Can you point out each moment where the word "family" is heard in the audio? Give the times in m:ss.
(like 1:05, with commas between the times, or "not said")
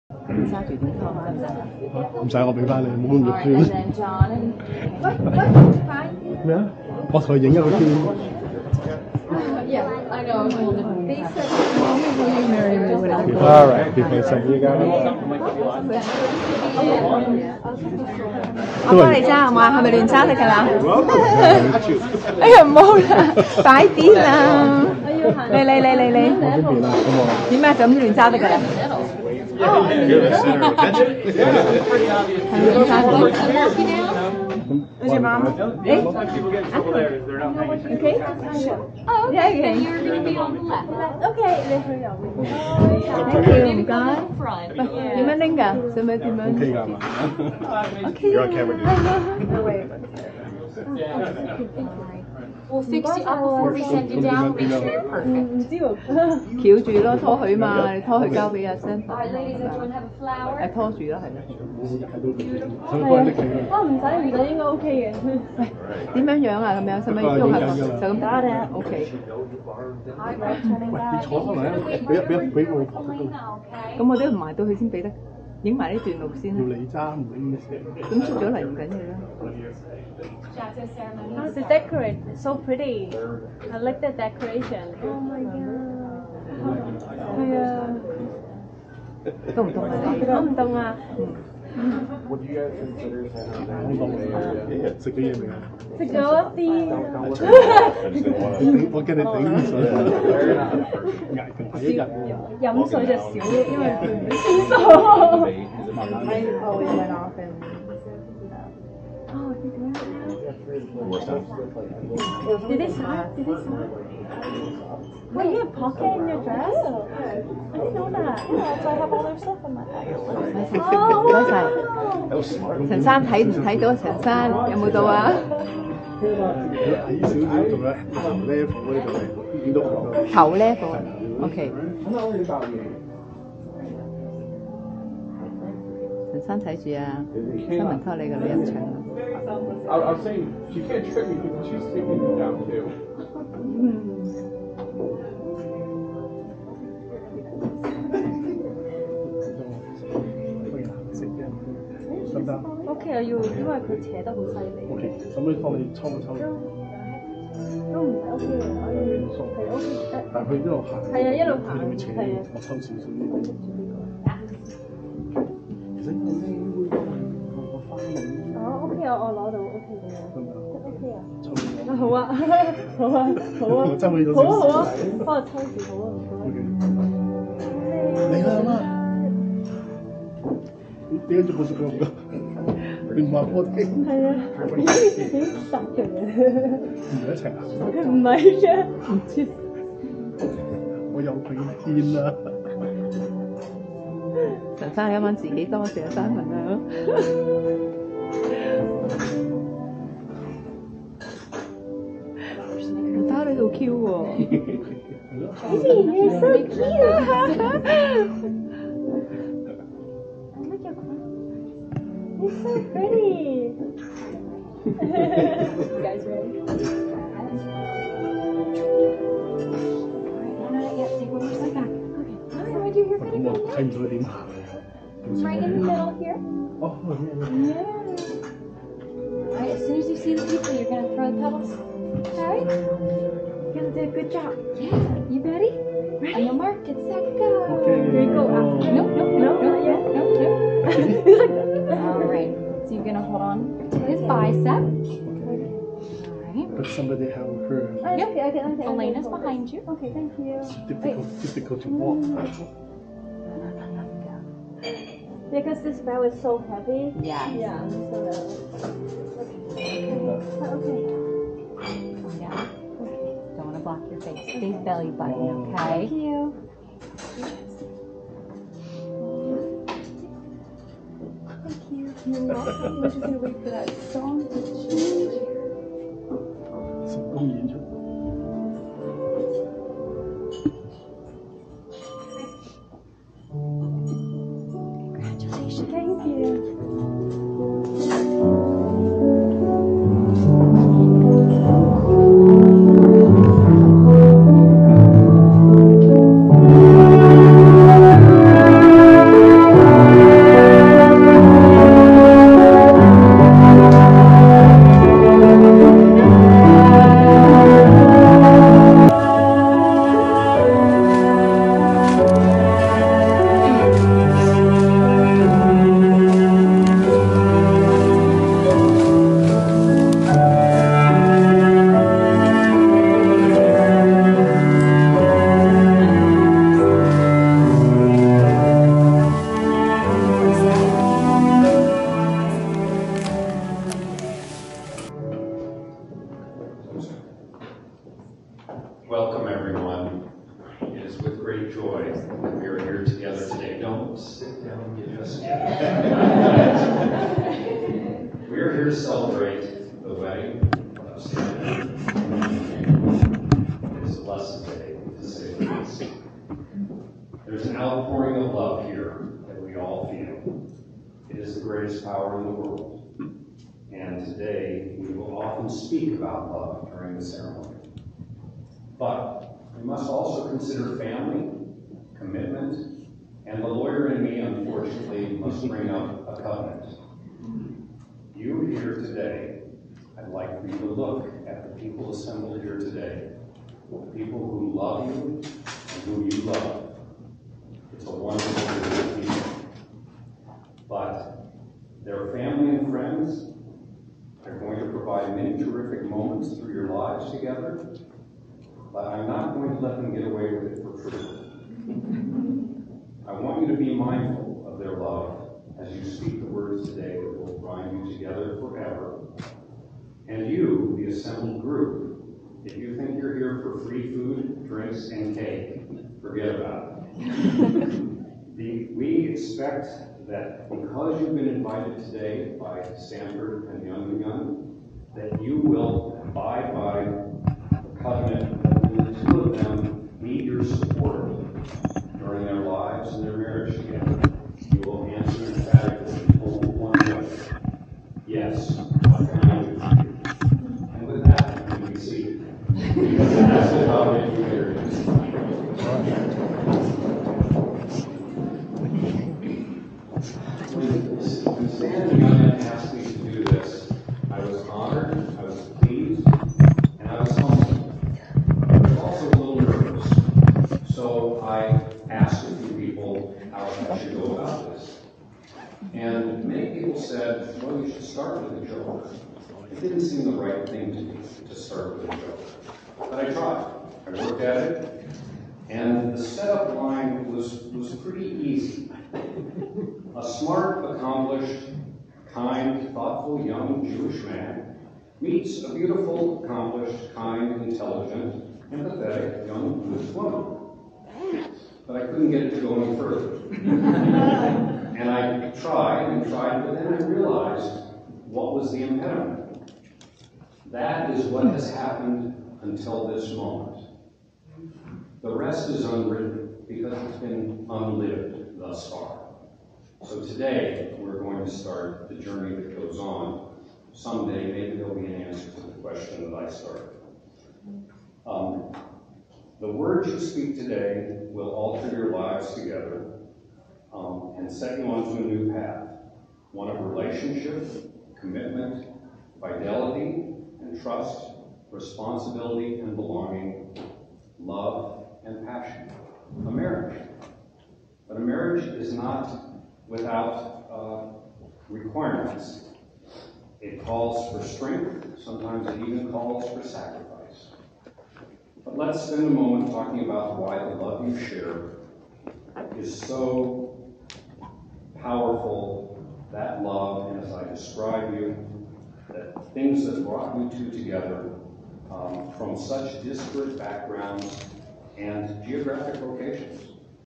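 6:10, 6:32.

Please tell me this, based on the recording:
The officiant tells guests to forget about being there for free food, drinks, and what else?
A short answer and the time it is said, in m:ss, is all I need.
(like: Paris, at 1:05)
cake, at 6:55.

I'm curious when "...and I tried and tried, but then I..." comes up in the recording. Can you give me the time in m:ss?
8:14.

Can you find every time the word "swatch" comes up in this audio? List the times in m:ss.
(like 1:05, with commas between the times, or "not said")
not said.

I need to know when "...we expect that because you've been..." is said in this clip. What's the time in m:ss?
6:58.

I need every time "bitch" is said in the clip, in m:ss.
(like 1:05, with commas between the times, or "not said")
not said.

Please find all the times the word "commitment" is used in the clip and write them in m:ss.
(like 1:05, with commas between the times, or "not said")
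6:12, 8:48.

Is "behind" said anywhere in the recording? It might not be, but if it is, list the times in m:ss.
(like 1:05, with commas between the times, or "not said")
4:09.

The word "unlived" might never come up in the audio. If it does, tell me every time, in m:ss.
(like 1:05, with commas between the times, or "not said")
8:27.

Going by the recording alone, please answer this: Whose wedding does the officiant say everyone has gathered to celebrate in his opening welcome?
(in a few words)
Samuel.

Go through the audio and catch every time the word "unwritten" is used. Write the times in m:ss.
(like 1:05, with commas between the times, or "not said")
8:25.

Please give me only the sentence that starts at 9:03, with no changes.
It calls for strength, sometimes it even calls for sacrifice.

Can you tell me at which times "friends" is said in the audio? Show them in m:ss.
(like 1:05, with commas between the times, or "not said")
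6:32.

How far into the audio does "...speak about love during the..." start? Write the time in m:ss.
6:05.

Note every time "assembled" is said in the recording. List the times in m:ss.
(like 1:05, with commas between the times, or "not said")
6:22, 6:51.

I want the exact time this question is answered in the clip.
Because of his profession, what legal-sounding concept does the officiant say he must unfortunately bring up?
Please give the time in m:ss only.
6:16.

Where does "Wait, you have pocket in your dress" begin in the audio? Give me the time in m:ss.
1:55.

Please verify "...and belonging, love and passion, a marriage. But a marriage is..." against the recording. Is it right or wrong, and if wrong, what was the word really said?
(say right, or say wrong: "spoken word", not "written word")
right.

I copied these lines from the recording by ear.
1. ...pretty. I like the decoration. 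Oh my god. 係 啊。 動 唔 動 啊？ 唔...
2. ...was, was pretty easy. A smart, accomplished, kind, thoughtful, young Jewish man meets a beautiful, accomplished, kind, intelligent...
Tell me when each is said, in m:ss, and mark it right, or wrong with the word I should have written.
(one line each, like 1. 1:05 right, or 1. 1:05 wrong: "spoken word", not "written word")
1. 1:22 right
2. 7:57 right.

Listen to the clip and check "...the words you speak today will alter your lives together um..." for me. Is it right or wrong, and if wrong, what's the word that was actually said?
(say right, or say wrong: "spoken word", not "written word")
right.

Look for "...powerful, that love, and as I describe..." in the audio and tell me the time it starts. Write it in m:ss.
9:14.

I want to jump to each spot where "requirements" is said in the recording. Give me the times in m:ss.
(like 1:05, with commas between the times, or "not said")
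9:01.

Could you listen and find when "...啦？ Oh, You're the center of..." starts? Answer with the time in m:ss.
0:28.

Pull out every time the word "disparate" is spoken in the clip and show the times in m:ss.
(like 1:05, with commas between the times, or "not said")
9:23.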